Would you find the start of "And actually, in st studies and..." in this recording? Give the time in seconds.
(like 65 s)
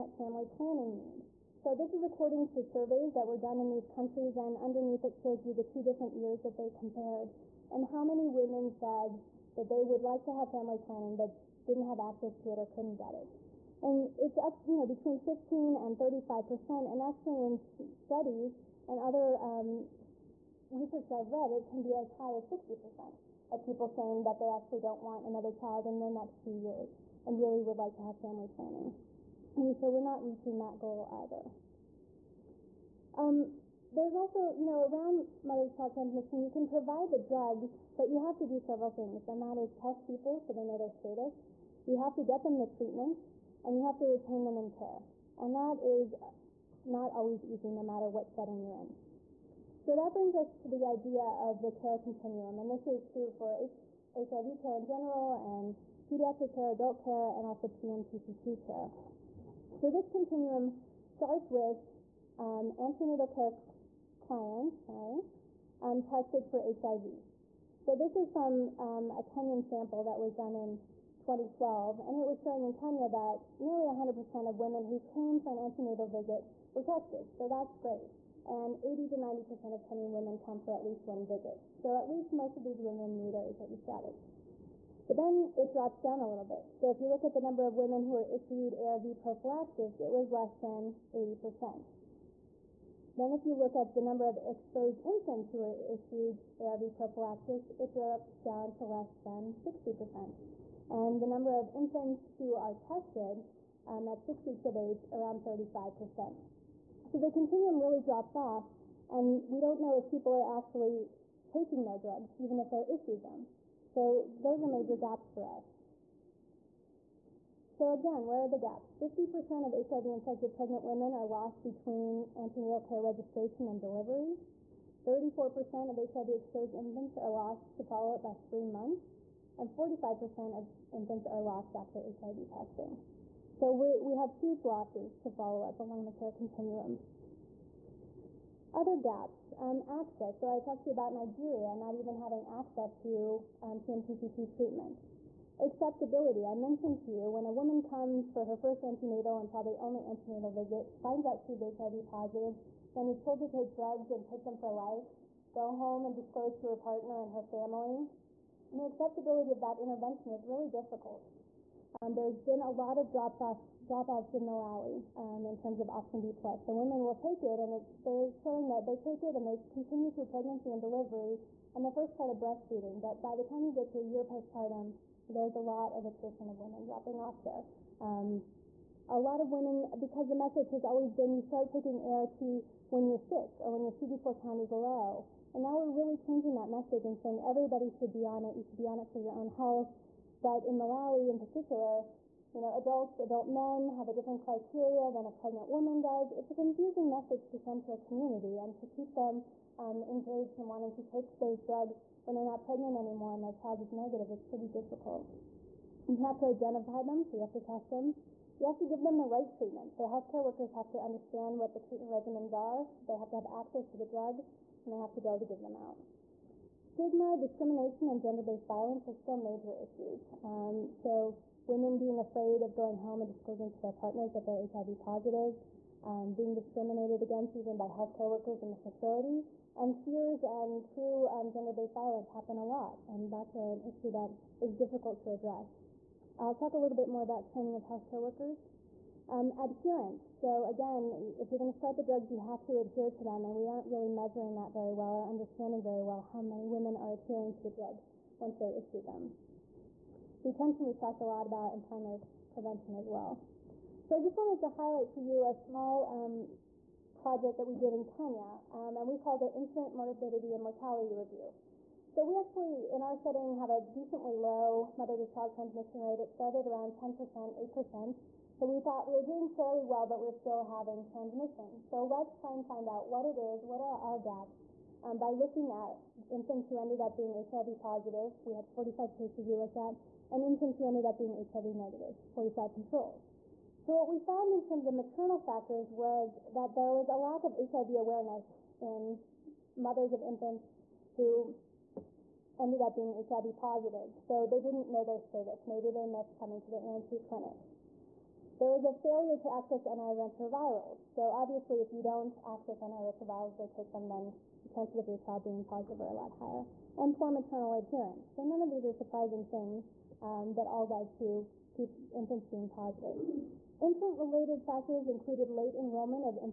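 16 s.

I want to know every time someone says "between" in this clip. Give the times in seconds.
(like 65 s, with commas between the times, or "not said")
14 s, 121 s.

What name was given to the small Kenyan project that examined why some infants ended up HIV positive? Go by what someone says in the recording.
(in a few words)
Infant Morbidity and Mortality Review.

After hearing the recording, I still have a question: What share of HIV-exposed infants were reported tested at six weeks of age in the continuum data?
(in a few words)
35%.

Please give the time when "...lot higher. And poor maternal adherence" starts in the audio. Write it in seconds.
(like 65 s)
306 s.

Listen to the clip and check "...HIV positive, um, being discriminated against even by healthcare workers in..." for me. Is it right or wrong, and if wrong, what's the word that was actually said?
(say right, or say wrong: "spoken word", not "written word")
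right.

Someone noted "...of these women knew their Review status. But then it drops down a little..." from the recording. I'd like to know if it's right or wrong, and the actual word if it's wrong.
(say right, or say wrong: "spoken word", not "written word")
wrong: "HIV", not "Review".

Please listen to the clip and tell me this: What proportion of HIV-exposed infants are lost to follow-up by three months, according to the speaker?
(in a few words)
34%.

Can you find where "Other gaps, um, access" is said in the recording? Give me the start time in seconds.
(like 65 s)
138 s.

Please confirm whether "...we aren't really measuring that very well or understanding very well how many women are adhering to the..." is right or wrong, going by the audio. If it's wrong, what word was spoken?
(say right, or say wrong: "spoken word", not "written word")
right.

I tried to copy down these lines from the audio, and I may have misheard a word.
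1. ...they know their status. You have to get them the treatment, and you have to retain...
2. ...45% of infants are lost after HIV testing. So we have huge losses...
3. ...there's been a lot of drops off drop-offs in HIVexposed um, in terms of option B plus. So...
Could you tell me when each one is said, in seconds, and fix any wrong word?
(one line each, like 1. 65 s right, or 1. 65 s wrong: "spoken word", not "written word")
1. 40 s right
2. 129 s right
3. 162 s wrong: "Malawi", not "HIVexposed".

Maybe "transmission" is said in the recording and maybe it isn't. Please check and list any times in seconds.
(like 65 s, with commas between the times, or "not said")
35 s, 265 s, 271 s.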